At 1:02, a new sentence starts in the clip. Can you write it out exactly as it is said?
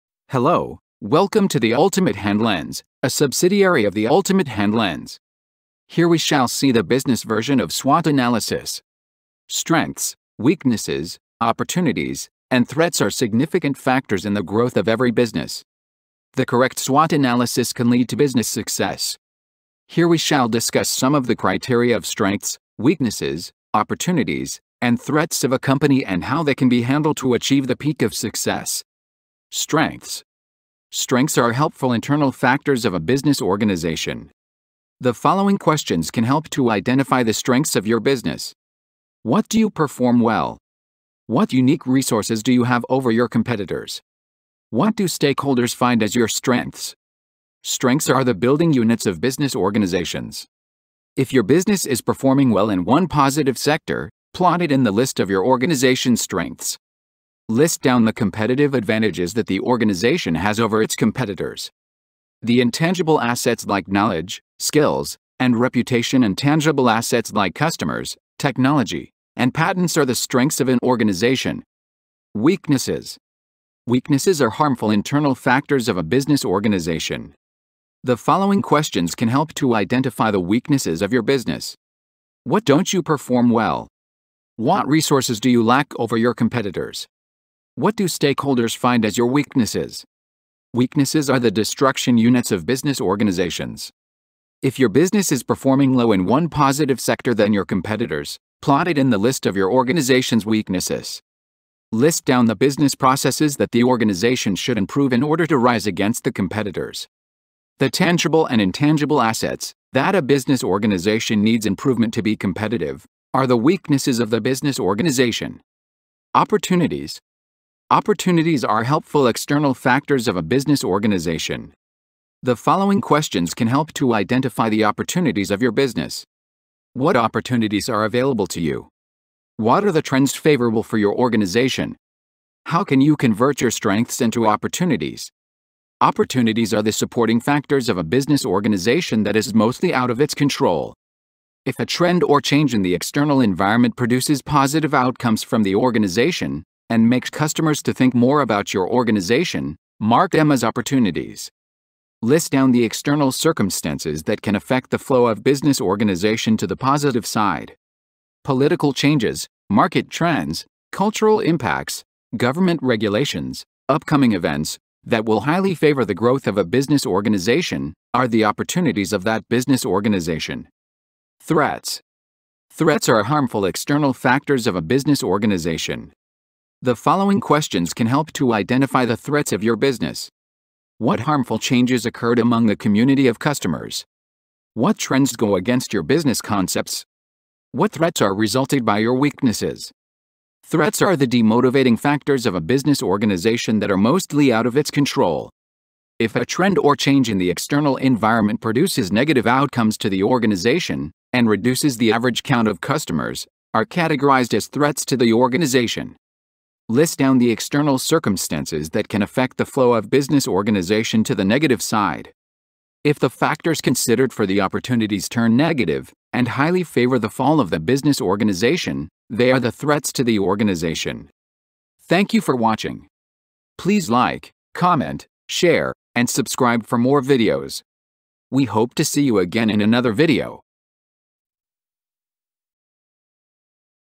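The intangible assets like knowledge, skills, and reputation and tangible assets like customers, technology, and patents are the strengths of an organization.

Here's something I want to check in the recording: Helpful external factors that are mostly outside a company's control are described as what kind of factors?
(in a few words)
supporting factors.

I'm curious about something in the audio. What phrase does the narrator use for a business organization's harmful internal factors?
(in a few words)
destruction units.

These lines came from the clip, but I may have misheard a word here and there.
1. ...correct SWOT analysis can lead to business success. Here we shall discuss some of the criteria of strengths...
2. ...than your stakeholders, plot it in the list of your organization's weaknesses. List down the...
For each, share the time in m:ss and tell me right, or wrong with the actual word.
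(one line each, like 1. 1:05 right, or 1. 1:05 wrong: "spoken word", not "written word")
1. 0:16 right
2. 1:37 wrong: "competitors", not "stakeholders".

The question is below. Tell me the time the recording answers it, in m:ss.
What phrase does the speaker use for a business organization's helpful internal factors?
0:48.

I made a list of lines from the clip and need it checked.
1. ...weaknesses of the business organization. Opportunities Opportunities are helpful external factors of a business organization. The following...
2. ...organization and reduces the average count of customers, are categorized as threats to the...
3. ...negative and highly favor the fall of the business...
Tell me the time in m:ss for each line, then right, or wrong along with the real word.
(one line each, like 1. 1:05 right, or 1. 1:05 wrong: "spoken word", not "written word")
1. 1:53 right
2. 3:20 right
3. 3:35 right.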